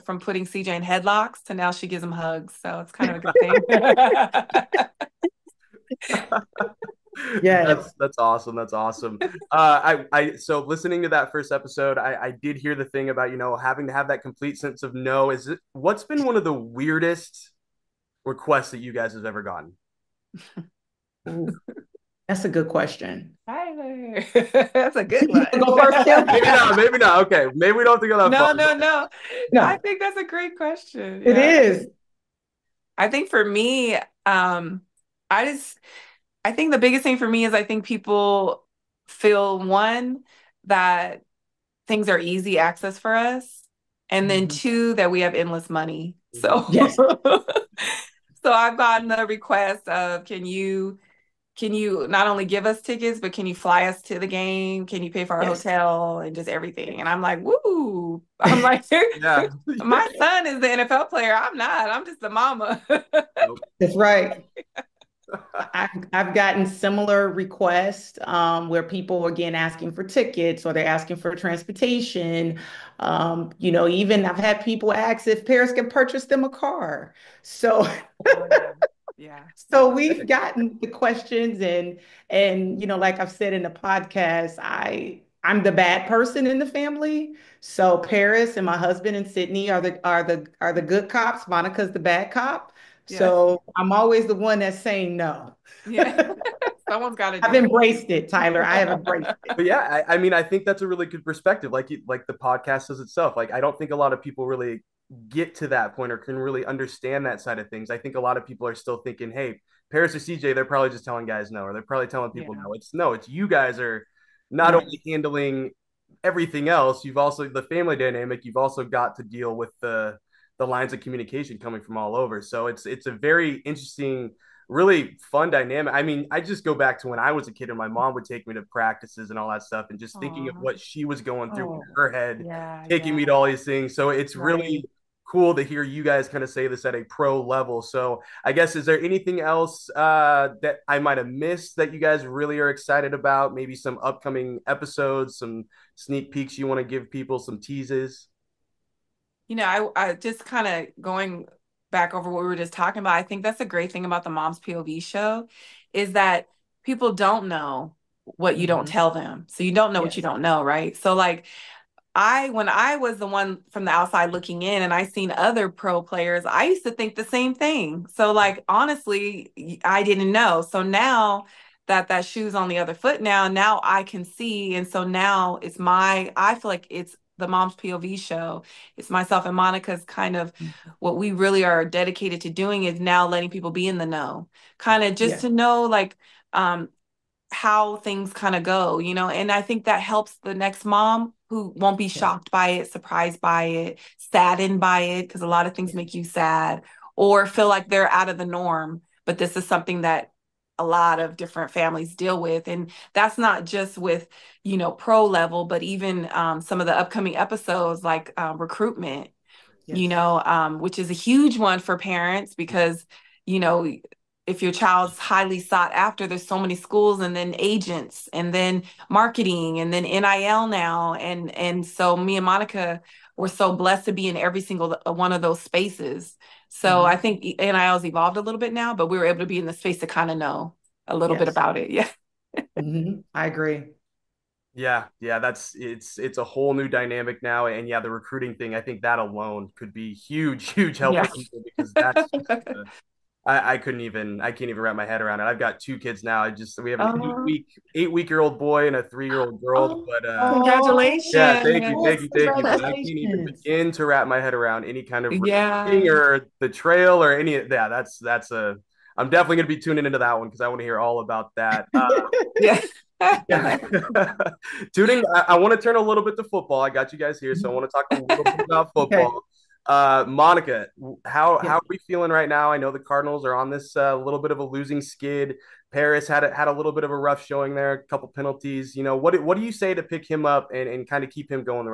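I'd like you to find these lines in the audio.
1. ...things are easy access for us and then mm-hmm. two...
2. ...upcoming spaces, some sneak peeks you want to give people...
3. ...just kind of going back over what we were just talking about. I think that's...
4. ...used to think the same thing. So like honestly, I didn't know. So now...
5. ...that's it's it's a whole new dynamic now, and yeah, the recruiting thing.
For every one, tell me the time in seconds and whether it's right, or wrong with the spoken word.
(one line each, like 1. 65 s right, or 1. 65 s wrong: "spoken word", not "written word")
1. 41 s right
2. 144 s wrong: "episodes", not "spaces"
3. 150 s right
4. 166 s right
5. 235 s right.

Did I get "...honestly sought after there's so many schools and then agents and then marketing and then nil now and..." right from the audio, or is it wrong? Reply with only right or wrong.
wrong.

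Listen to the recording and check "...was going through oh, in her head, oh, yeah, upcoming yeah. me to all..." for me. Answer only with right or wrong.
wrong.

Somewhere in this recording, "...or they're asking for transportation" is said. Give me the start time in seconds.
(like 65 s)
70 s.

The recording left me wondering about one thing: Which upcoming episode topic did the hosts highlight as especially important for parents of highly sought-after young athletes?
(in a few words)
Recruitment.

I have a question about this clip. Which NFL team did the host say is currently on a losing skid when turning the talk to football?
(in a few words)
Cardinals.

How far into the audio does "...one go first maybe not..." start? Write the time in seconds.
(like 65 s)
25 s.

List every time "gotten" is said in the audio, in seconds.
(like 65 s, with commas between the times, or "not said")
19 s, 48 s, 66 s, 80 s.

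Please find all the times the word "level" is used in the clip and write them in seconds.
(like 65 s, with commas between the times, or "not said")
137 s, 205 s.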